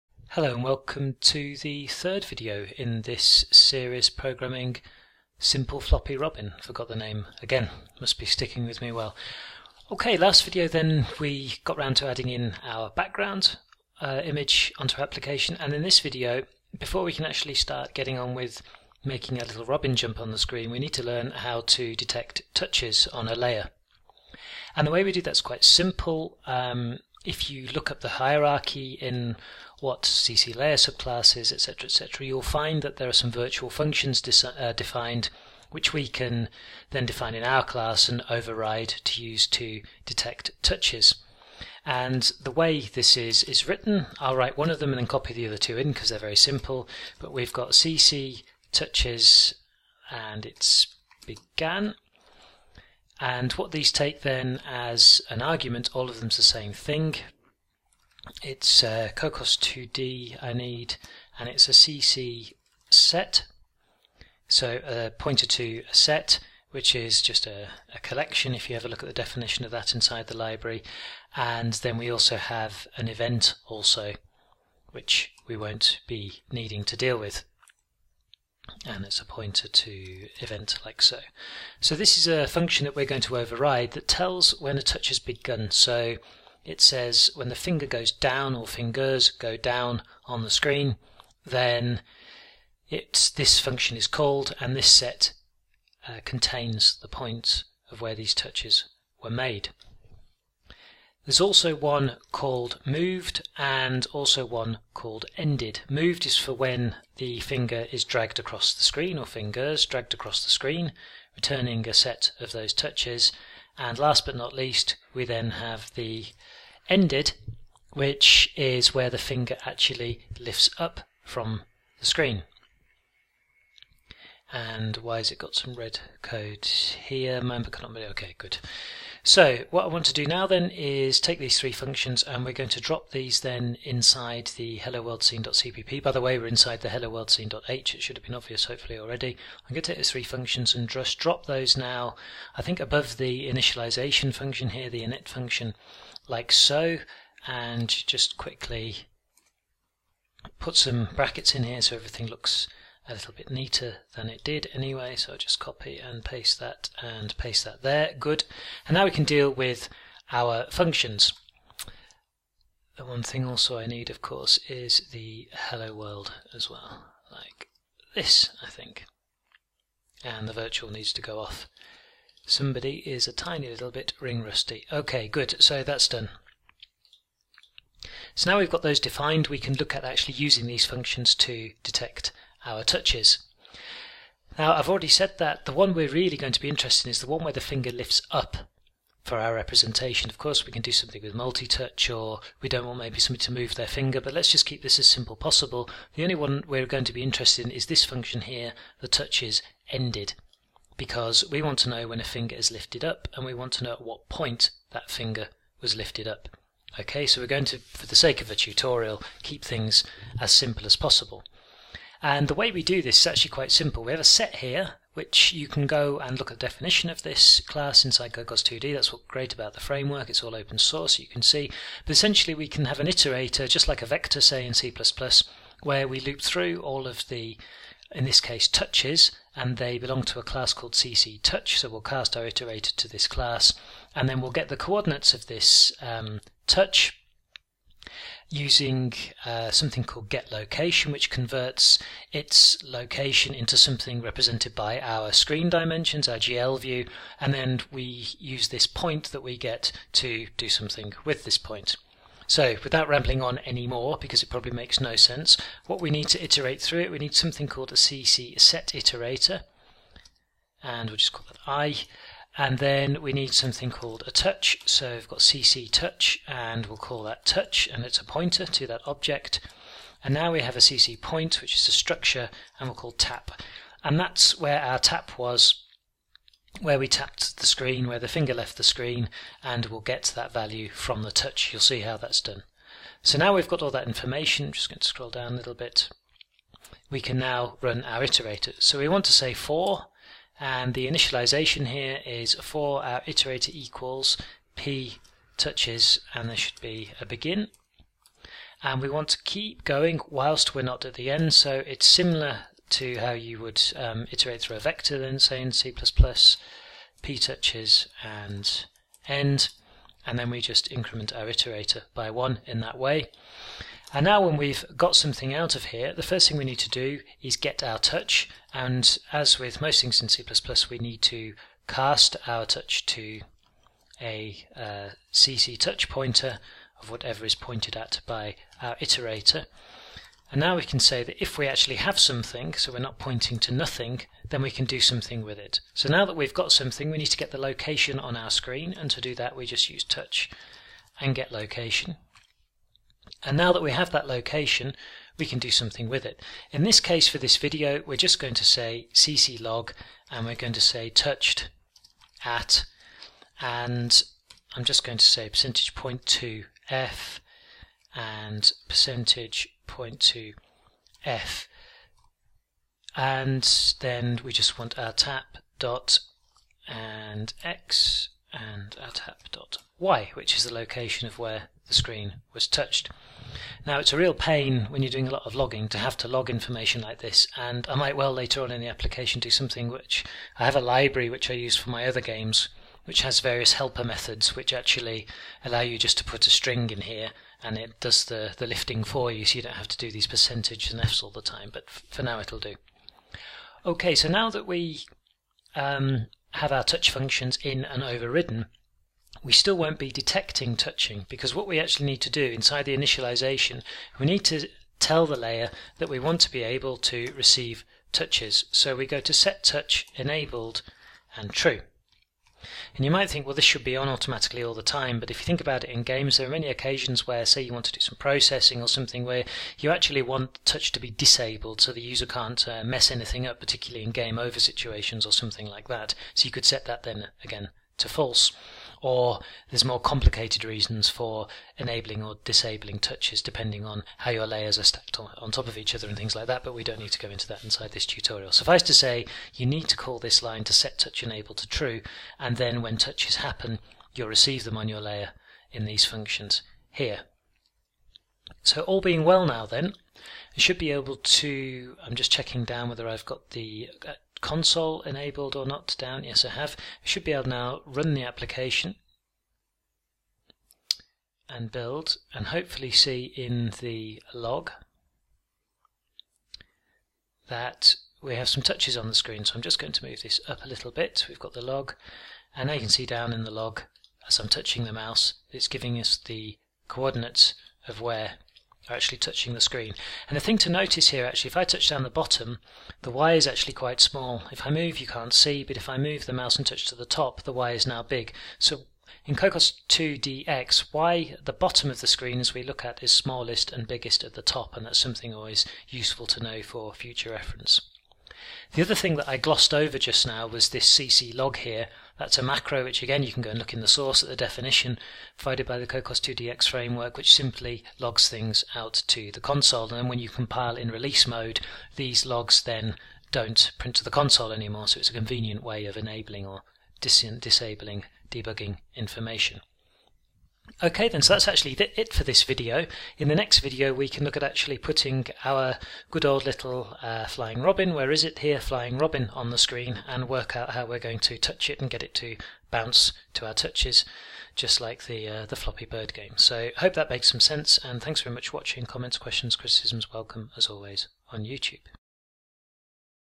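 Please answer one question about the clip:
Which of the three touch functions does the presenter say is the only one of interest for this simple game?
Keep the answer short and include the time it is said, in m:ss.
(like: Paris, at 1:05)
touches ended, at 3:19.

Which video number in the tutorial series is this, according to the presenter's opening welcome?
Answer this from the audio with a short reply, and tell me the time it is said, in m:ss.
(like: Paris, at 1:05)
third, at 0:01.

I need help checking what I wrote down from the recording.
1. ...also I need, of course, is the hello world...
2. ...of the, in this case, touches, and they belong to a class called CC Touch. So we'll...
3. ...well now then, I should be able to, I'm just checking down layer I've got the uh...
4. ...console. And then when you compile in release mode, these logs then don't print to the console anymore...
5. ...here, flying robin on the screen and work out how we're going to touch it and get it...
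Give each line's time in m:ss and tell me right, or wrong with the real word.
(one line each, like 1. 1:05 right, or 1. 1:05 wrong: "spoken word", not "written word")
1. 2:43 right
2. 3:47 right
3. 7:29 wrong: "whether", not "layer"
4. 8:29 right
5. 8:48 right.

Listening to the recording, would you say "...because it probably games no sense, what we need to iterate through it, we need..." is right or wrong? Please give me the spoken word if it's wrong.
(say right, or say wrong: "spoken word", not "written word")
wrong: "makes", not "games".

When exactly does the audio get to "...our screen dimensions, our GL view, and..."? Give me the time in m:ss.
4:04.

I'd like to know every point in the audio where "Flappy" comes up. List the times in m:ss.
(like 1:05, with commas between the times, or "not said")
0:05, 8:55.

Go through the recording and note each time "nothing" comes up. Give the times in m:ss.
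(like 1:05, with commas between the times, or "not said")
5:33.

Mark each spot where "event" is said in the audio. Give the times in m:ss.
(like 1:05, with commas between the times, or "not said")
1:13, 1:20.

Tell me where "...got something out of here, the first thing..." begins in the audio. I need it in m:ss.
5:14.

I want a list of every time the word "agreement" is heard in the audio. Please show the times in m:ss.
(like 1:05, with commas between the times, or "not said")
not said.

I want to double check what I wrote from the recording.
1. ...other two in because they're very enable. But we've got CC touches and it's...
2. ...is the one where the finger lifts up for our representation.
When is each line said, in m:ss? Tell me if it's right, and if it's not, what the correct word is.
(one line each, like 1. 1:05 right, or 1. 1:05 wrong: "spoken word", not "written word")
1. 0:45 wrong: "simple", not "enable"
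2. 3:07 right.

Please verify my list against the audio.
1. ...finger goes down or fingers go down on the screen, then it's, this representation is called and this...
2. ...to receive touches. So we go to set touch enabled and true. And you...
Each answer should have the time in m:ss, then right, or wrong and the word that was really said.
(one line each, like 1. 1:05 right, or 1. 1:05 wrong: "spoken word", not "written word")
1. 1:27 wrong: "function", not "representation"
2. 6:46 right.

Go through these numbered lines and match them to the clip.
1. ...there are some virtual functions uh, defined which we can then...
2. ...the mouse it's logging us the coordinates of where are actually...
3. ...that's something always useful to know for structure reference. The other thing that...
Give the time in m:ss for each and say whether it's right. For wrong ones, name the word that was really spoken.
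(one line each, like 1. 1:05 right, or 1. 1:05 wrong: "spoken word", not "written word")
1. 0:32 right
2. 7:54 wrong: "giving", not "logging"
3. 8:14 wrong: "future", not "structure".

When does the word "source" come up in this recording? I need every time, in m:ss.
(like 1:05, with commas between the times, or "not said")
3:40, 8:23.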